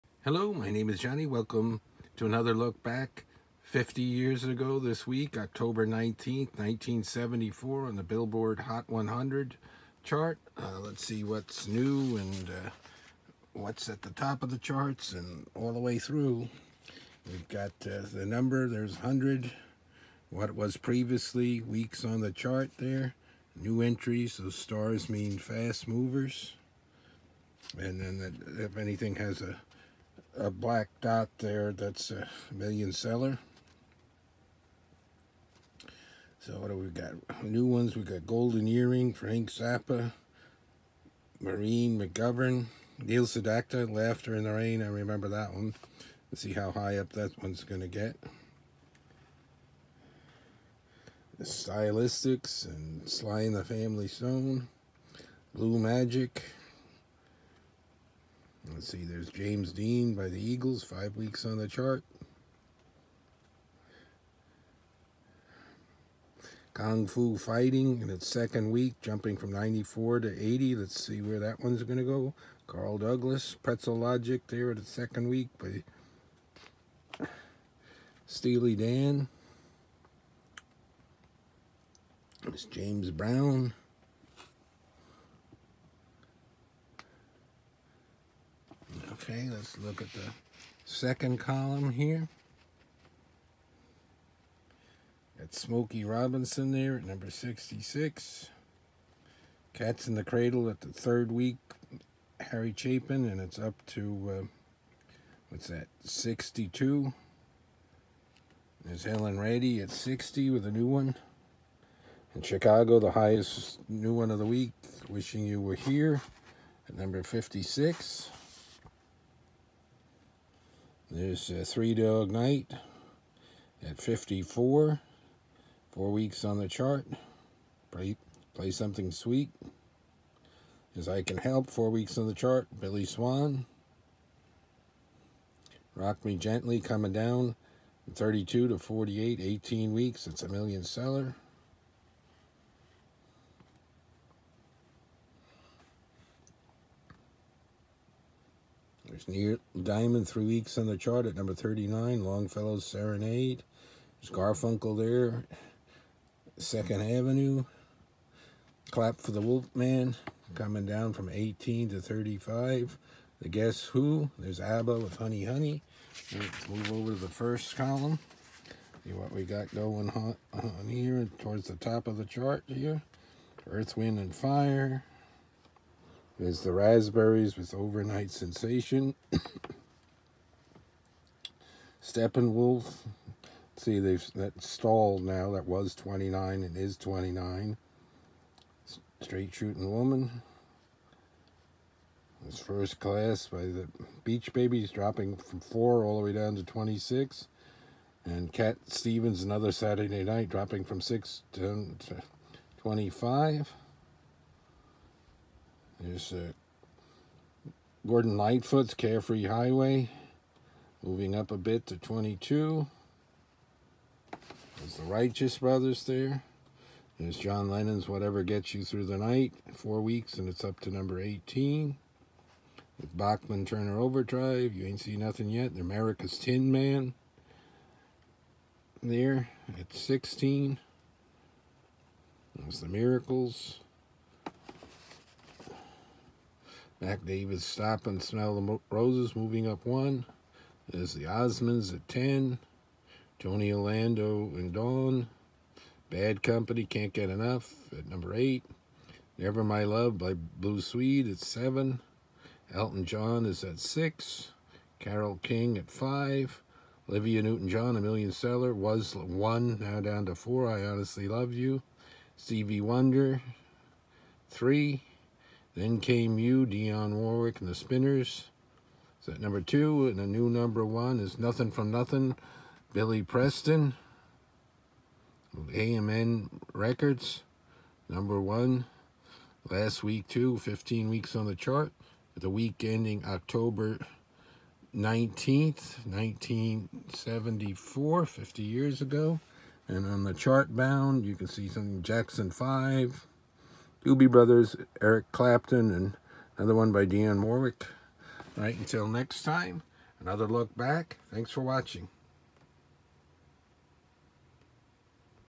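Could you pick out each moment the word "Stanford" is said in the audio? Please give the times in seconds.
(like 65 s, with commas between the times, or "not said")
not said.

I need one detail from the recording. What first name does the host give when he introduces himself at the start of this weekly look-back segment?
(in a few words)
Johnny.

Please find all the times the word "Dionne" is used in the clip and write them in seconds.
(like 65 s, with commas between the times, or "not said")
266 s, 297 s.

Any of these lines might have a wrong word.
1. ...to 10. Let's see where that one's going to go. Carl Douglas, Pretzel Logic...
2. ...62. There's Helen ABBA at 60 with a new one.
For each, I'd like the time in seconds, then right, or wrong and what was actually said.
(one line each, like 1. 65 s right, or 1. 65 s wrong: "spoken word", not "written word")
1. 70 s wrong: "80", not "10"
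2. 106 s wrong: "Reddy", not "ABBA".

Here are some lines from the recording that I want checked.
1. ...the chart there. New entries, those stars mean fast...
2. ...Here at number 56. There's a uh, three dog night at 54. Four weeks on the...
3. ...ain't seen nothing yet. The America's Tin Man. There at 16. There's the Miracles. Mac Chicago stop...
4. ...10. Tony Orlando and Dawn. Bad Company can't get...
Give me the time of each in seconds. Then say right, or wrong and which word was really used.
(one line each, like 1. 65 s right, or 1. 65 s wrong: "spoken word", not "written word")
1. 22 s right
2. 115 s right
3. 224 s wrong: "Davis", not "Chicago"
4. 242 s right.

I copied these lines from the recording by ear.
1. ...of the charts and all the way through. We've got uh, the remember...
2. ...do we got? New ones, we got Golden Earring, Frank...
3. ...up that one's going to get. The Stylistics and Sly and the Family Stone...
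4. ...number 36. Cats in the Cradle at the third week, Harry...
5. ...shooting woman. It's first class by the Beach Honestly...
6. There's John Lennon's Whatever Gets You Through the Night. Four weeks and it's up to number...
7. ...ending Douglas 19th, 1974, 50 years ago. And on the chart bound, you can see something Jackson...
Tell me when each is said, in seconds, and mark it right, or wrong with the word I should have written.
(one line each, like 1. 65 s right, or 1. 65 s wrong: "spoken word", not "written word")
1. 14 s wrong: "number", not "remember"
2. 36 s right
3. 46 s right
4. 97 s wrong: "66", not "36"
5. 189 s wrong: "Babies", not "Honestly"
6. 217 s right
7. 282 s wrong: "October", not "Douglas".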